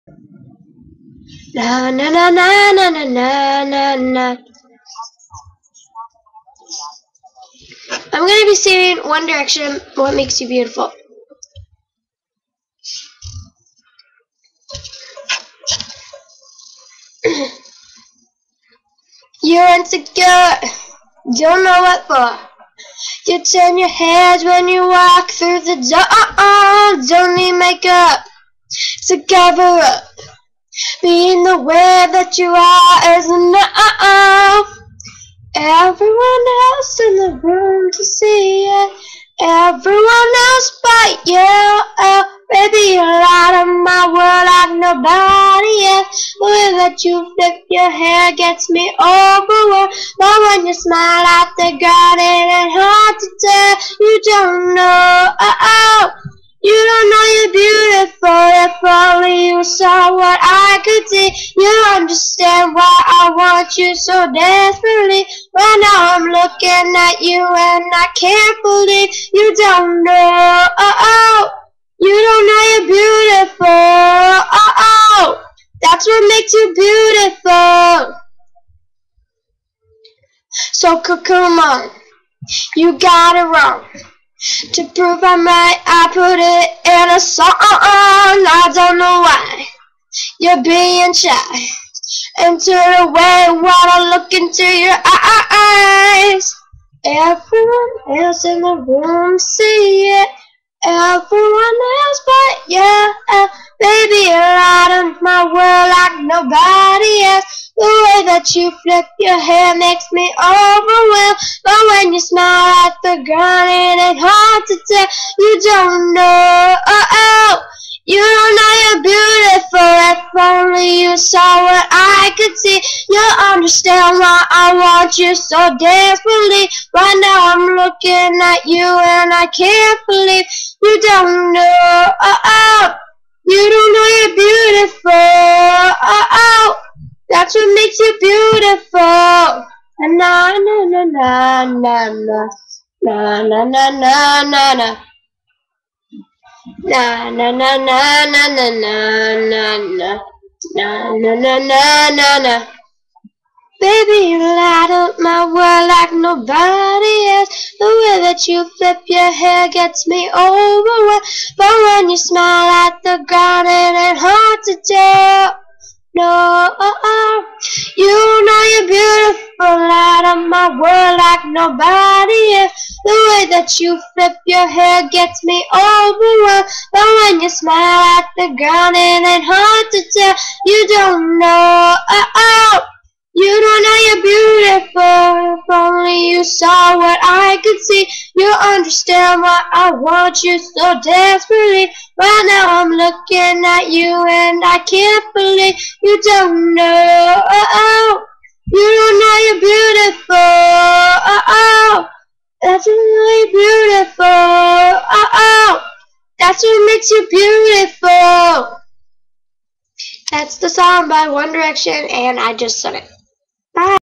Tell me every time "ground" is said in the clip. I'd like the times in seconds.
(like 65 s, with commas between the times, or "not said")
113 s, 163 s, 178 s.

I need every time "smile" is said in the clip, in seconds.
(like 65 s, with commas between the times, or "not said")
50 s, 112 s, 162 s, 177 s.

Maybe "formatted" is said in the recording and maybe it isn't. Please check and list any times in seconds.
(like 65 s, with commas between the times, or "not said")
not said.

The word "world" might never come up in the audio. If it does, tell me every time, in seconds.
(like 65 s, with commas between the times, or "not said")
44 s, 155 s, 170 s.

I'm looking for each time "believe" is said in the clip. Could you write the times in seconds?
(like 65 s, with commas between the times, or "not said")
68 s, 130 s, 195 s.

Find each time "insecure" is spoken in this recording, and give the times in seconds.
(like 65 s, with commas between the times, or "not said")
19 s.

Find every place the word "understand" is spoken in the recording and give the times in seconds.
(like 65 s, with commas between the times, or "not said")
61 s, 123 s, 188 s.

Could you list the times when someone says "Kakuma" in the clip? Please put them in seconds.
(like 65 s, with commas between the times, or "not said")
81 s.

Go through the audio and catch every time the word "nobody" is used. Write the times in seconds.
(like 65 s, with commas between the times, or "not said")
44 s, 156 s, 171 s.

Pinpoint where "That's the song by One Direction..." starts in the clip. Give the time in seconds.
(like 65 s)
210 s.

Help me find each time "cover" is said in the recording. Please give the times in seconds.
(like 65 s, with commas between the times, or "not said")
29 s.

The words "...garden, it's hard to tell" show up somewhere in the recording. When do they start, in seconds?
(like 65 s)
51 s.